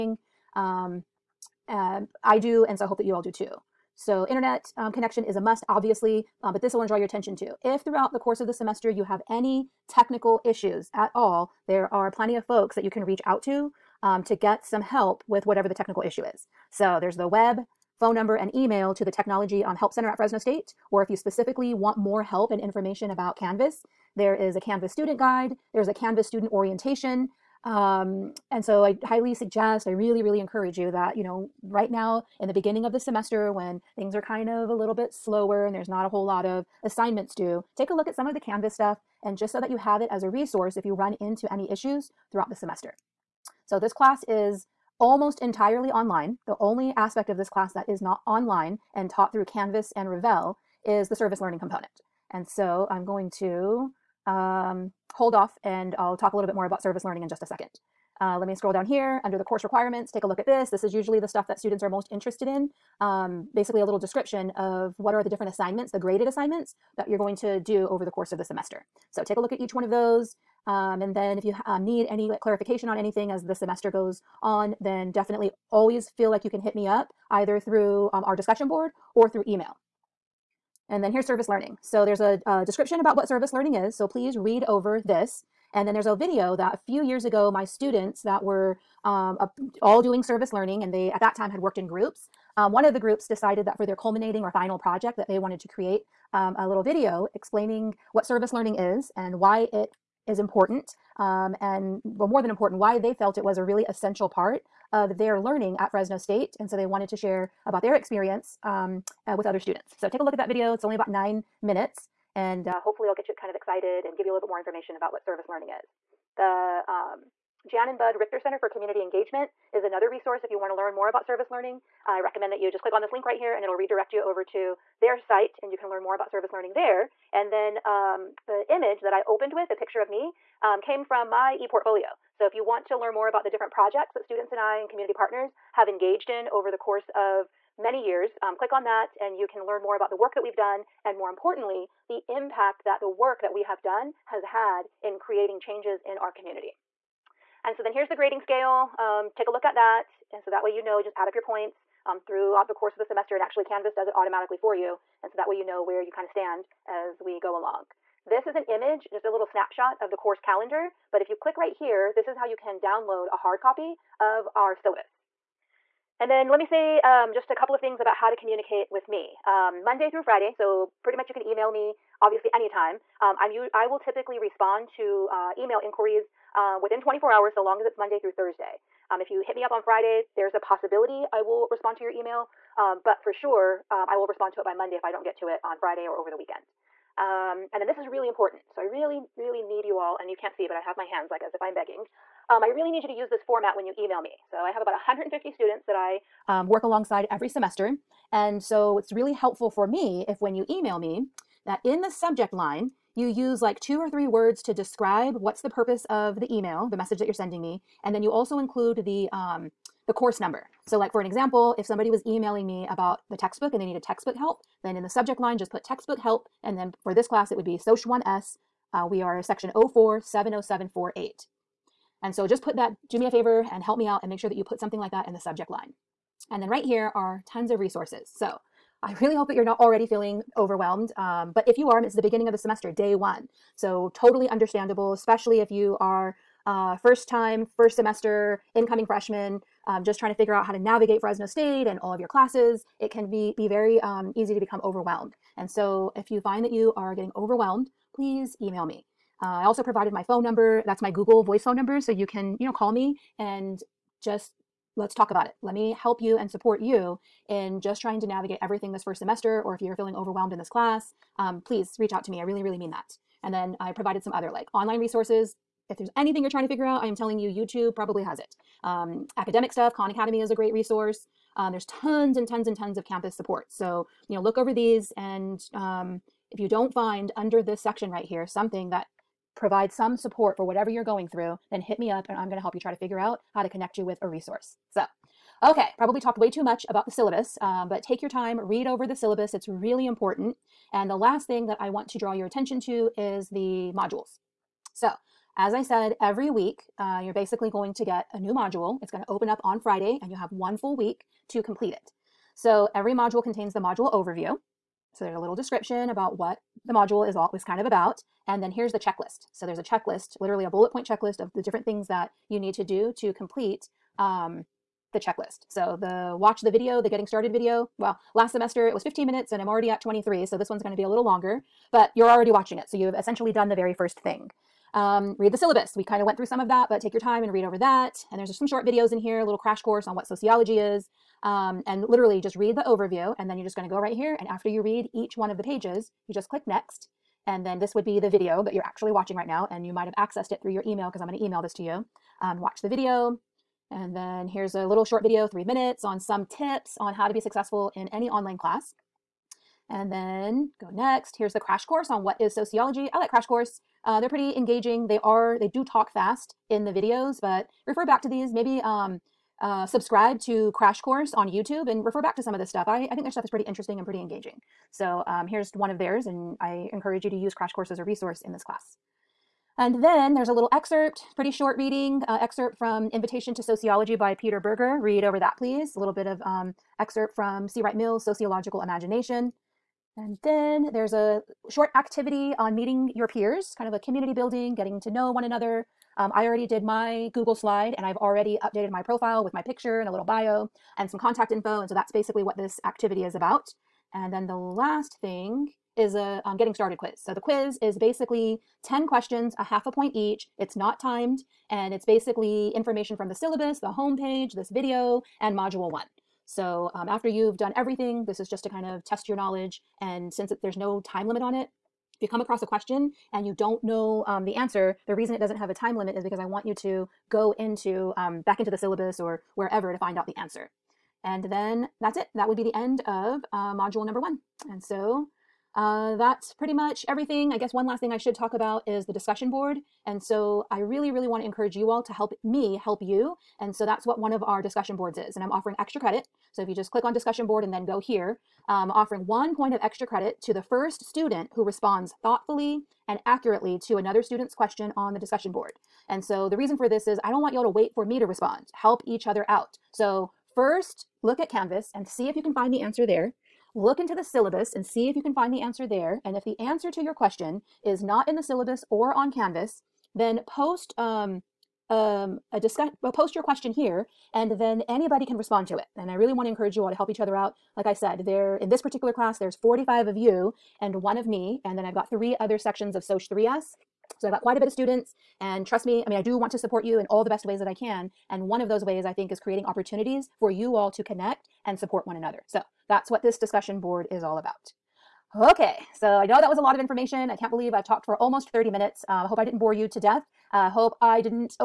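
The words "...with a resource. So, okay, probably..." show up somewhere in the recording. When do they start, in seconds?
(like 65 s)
284 s.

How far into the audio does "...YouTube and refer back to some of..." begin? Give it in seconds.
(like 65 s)
361 s.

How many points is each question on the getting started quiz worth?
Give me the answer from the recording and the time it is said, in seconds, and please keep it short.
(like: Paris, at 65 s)
half a point, at 399 s.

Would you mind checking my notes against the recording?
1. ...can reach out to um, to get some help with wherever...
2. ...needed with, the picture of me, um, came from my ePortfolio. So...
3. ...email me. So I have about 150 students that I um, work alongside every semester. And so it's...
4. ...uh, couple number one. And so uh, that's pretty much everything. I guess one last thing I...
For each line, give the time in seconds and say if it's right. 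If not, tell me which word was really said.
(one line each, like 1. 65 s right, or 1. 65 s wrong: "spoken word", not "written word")
1. 12 s wrong: "whatever", not "wherever"
2. 129 s wrong: "opened", not "needed"
3. 193 s right
4. 423 s wrong: "module", not "couple".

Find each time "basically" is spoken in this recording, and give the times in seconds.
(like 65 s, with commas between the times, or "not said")
63 s, 297 s, 392 s, 397 s, 402 s.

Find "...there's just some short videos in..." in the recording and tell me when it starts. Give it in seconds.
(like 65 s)
328 s.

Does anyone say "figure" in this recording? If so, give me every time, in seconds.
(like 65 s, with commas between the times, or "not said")
240 s, 266 s, 282 s.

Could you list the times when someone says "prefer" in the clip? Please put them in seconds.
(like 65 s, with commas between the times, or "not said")
not said.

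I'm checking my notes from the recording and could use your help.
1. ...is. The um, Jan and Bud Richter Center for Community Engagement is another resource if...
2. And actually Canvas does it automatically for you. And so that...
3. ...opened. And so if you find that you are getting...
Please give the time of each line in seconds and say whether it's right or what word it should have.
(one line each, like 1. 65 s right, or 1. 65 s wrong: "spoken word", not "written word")
1. 115 s right
2. 153 s right
3. 244 s wrong: "overwhelmed", not "opened".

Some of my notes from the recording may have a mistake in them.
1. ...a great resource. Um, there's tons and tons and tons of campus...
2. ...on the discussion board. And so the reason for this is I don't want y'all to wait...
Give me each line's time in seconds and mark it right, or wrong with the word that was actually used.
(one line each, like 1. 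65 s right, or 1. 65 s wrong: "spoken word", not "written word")
1. 270 s right
2. 444 s right.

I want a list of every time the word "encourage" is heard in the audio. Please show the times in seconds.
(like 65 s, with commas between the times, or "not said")
30 s, 366 s, 431 s, 466 s.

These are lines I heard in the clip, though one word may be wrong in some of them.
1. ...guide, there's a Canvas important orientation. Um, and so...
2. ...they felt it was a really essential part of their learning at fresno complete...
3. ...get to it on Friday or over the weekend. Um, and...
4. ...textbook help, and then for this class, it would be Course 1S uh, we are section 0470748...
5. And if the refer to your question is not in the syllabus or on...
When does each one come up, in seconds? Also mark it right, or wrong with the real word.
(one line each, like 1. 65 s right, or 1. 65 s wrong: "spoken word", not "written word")
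1. 25 s wrong: "student", not "important"
2. 102 s wrong: "state", not "complete"
3. 185 s right
4. 215 s wrong: "SOC", not "Course"
5. 456 s wrong: "answer", not "refer".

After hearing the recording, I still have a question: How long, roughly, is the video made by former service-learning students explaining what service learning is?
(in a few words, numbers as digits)
9 minutes.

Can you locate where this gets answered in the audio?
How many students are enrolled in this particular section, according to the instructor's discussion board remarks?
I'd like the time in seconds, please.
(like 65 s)
469 s.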